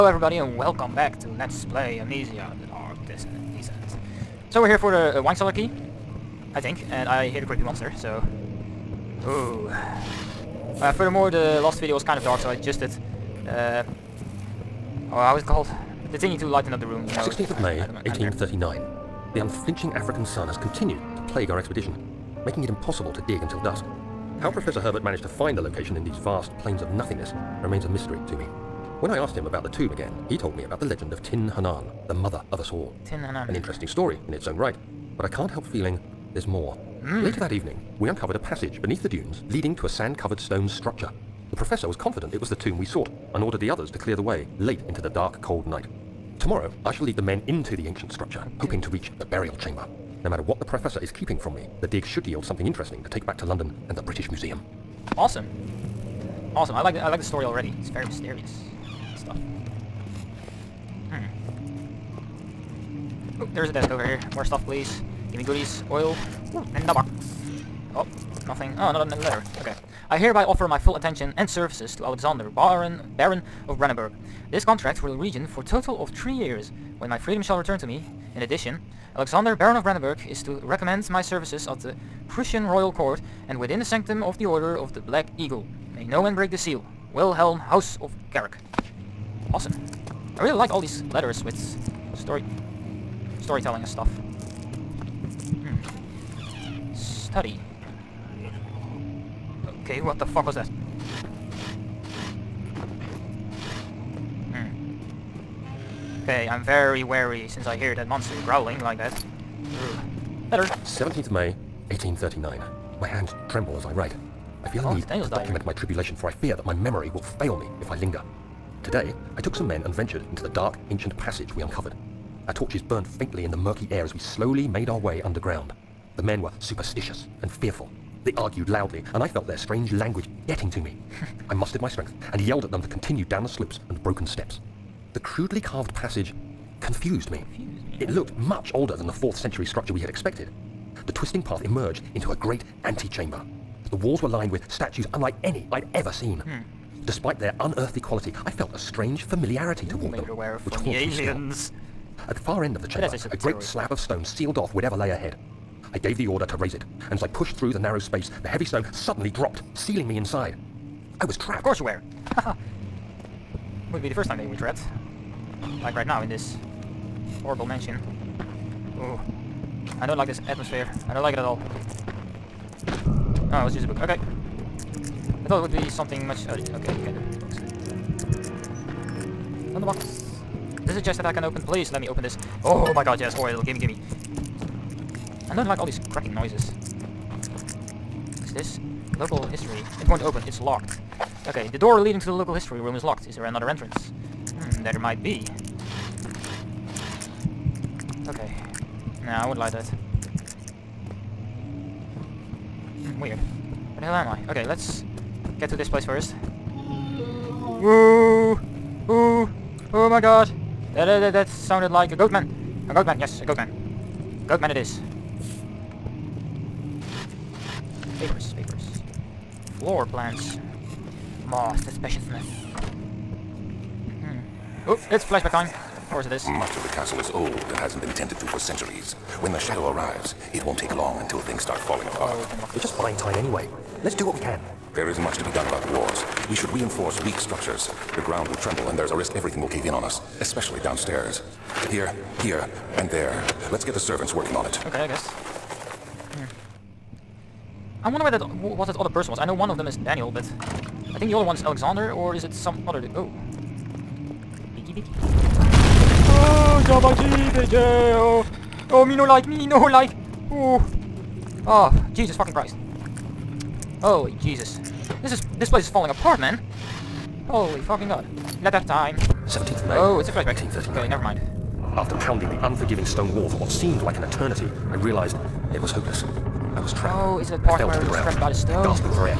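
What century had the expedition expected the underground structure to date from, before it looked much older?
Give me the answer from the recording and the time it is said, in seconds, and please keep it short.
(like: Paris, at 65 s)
4th century, at 139 s.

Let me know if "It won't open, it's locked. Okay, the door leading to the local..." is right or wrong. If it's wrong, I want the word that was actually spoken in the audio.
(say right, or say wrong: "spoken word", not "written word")
right.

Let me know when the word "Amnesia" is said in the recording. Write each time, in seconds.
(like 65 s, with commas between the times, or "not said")
1 s.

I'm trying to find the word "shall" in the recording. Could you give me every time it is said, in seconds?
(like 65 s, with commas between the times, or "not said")
46 s, 77 s.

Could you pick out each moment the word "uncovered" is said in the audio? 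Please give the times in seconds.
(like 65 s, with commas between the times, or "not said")
38 s, 121 s.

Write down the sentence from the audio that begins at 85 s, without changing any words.
May no one break the seal.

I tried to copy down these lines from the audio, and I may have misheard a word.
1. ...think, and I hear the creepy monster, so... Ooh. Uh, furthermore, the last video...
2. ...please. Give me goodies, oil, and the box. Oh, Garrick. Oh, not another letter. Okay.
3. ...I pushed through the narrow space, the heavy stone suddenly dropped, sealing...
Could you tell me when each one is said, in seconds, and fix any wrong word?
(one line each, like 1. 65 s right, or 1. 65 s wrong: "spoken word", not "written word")
1. 6 s right
2. 64 s wrong: "Nothing", not "Garrick"
3. 157 s right.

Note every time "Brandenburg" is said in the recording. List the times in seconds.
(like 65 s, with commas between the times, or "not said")
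73 s, 79 s.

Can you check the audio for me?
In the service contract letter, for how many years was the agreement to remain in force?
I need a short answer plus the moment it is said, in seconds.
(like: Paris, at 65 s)
3, at 76 s.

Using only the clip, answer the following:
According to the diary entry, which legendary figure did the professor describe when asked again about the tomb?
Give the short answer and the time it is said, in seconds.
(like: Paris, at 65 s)
Tin Hinan, at 31 s.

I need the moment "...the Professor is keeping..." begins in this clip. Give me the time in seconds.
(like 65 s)
50 s.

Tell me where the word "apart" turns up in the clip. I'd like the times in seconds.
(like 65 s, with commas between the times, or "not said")
232 s, 266 s.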